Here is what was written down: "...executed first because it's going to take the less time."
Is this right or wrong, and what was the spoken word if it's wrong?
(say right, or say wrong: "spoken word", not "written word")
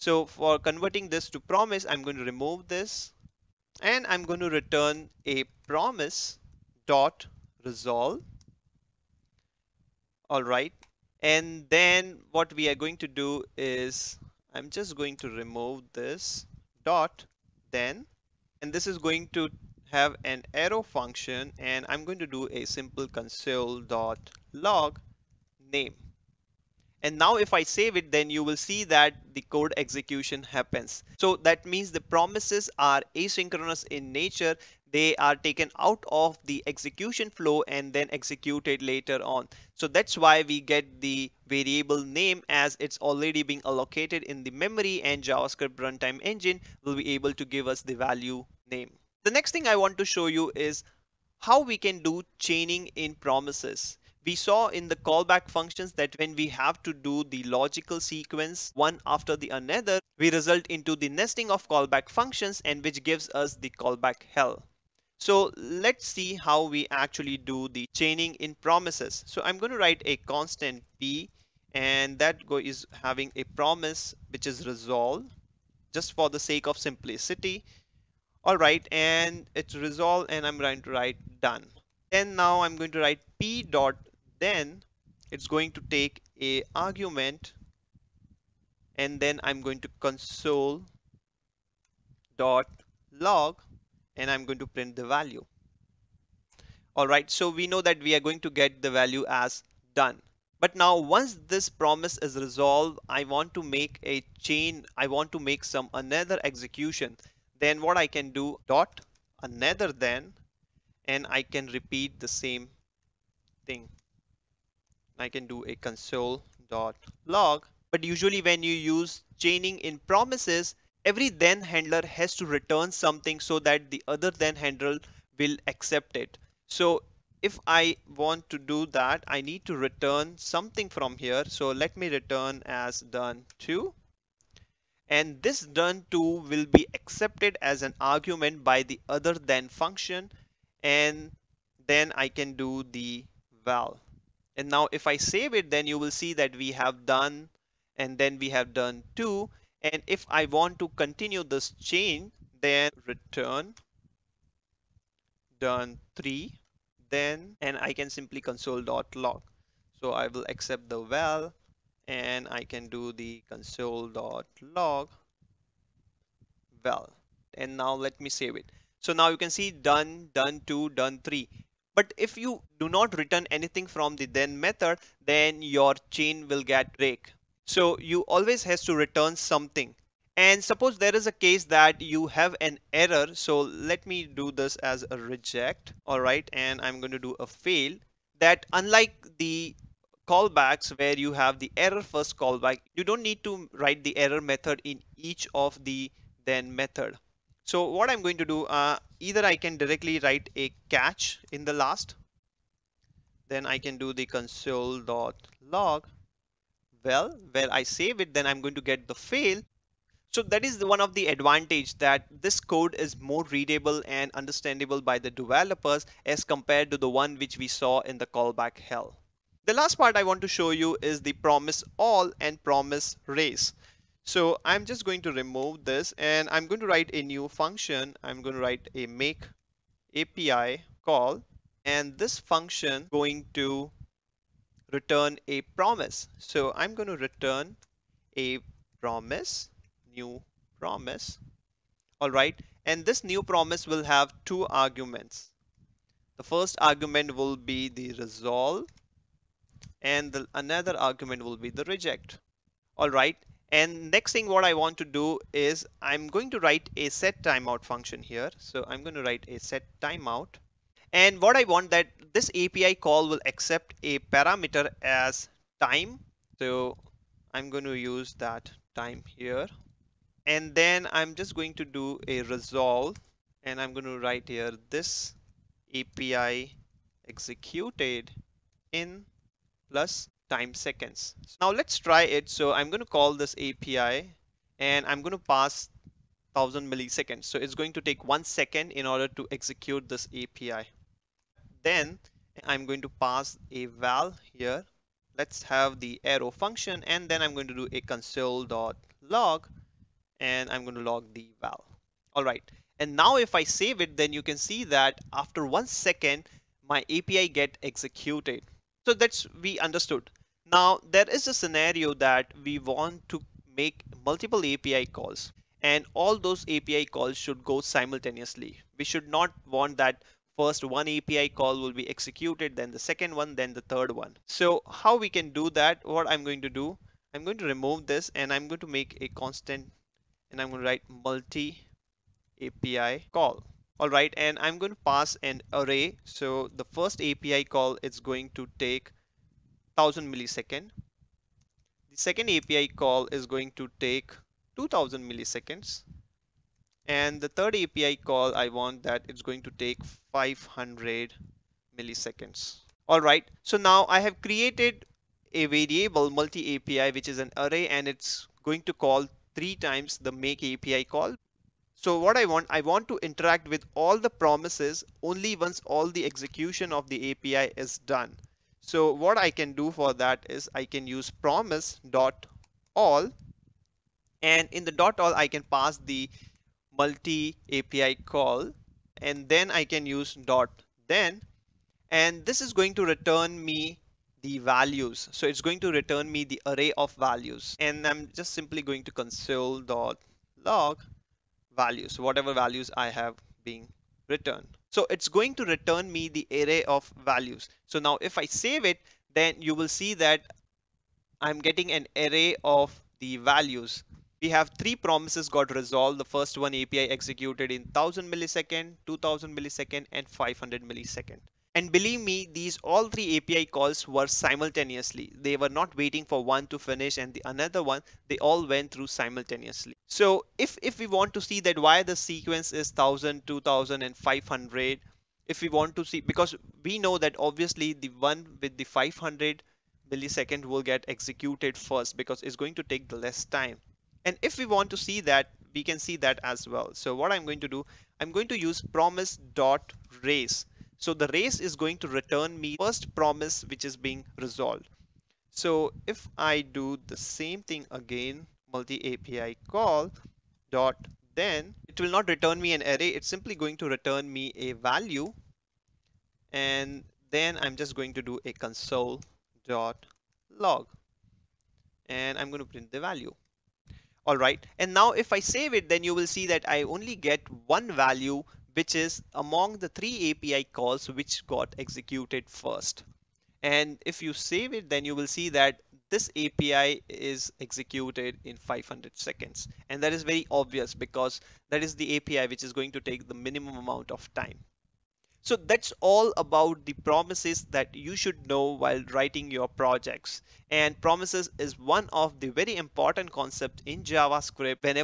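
right.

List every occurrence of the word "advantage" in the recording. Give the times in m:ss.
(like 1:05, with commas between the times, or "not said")
3:31.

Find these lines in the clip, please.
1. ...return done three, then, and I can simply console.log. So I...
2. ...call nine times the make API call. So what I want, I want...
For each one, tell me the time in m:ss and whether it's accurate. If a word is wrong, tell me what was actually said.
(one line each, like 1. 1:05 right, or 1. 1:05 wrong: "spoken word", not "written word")
1. 2:33 right
2. 5:58 wrong: "three", not "nine".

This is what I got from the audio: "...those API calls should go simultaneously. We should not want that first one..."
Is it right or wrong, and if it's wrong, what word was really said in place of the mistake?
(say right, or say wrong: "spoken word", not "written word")
right.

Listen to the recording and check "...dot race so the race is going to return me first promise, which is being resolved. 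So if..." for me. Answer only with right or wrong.
right.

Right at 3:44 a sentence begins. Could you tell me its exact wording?
So I'm just going to remove this and I'm going to write a new function.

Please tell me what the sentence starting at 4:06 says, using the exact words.
The first argument will be the resolve and the, another argument will be the reject.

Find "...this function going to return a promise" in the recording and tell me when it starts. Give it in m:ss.
3:52.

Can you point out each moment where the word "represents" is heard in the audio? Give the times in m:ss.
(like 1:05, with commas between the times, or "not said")
not said.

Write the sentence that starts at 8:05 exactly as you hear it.
So that's all about the promises that you should know while writing your projects.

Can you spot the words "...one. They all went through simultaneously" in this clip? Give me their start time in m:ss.
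6:57.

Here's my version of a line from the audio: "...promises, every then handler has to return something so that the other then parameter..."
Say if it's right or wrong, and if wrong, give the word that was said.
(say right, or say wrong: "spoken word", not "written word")
wrong: "handler", not "parameter".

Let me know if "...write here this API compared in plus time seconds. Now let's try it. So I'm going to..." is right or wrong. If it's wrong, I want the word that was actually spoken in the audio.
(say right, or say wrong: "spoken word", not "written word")
wrong: "executed", not "compared".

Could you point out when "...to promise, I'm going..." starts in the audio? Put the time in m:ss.
0:01.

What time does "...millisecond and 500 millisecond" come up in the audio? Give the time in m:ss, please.
6:49.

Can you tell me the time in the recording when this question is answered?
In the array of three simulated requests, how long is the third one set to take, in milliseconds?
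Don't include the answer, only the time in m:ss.
5:50.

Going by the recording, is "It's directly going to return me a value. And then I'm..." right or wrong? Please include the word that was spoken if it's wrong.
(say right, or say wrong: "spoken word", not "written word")
wrong: "simply", not "directly".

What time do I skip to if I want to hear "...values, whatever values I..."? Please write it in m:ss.
6:31.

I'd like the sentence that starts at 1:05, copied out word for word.
So let's see how we actually do the chaining in promises.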